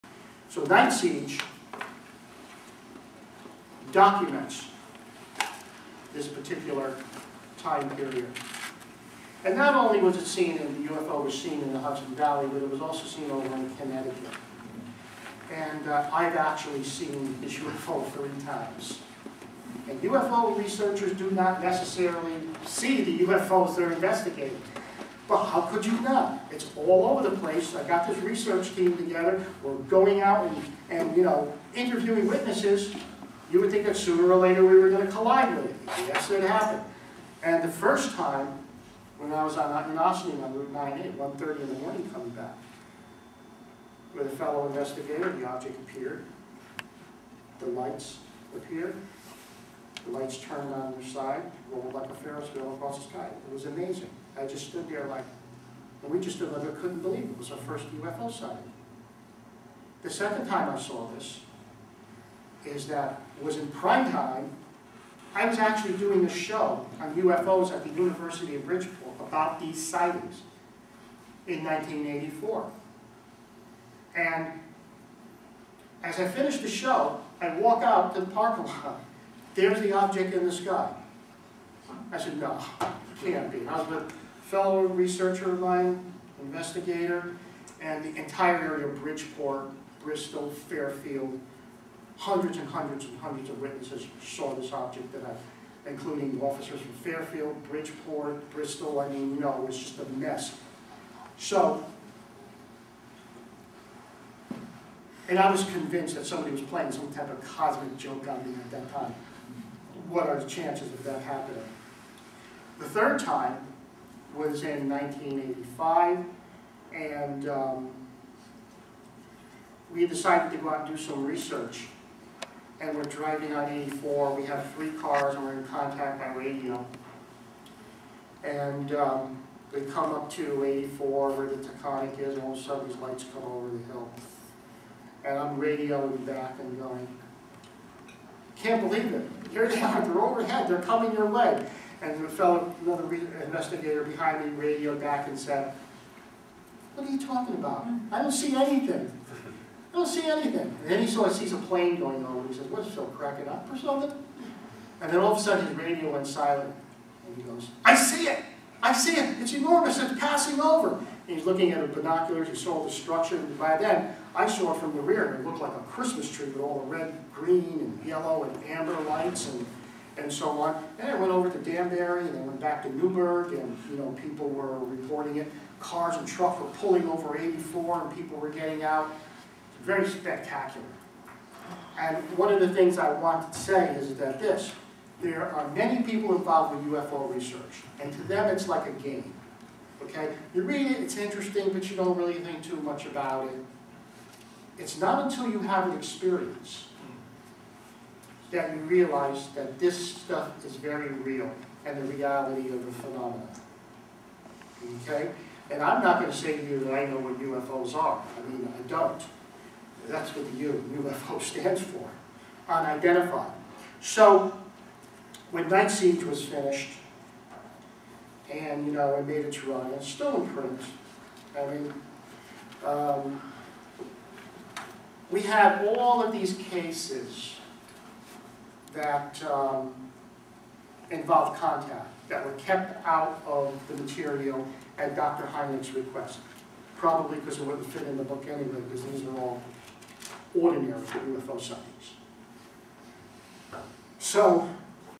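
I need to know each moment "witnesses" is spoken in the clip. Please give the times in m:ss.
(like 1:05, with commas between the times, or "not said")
0:32, 1:33.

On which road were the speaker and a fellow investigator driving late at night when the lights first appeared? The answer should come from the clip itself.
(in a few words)
Route 98.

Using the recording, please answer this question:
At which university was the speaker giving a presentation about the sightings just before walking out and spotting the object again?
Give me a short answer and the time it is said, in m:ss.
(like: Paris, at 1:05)
University of Bridgeport, at 1:07.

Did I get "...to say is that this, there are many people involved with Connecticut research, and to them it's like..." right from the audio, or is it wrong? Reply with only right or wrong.
wrong.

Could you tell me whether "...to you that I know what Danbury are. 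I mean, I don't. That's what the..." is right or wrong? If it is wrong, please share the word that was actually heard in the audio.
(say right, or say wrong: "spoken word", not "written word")
wrong: "UFOs", not "Danbury".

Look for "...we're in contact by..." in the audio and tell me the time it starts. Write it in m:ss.
2:05.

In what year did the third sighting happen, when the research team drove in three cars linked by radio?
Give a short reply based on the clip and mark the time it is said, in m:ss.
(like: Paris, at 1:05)
1985, at 1:54.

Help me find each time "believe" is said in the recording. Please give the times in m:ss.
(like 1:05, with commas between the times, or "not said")
0:57, 2:18.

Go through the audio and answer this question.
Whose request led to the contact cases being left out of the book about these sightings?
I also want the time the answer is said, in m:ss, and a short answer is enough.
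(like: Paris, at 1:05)
Dr. Hynek, at 3:55.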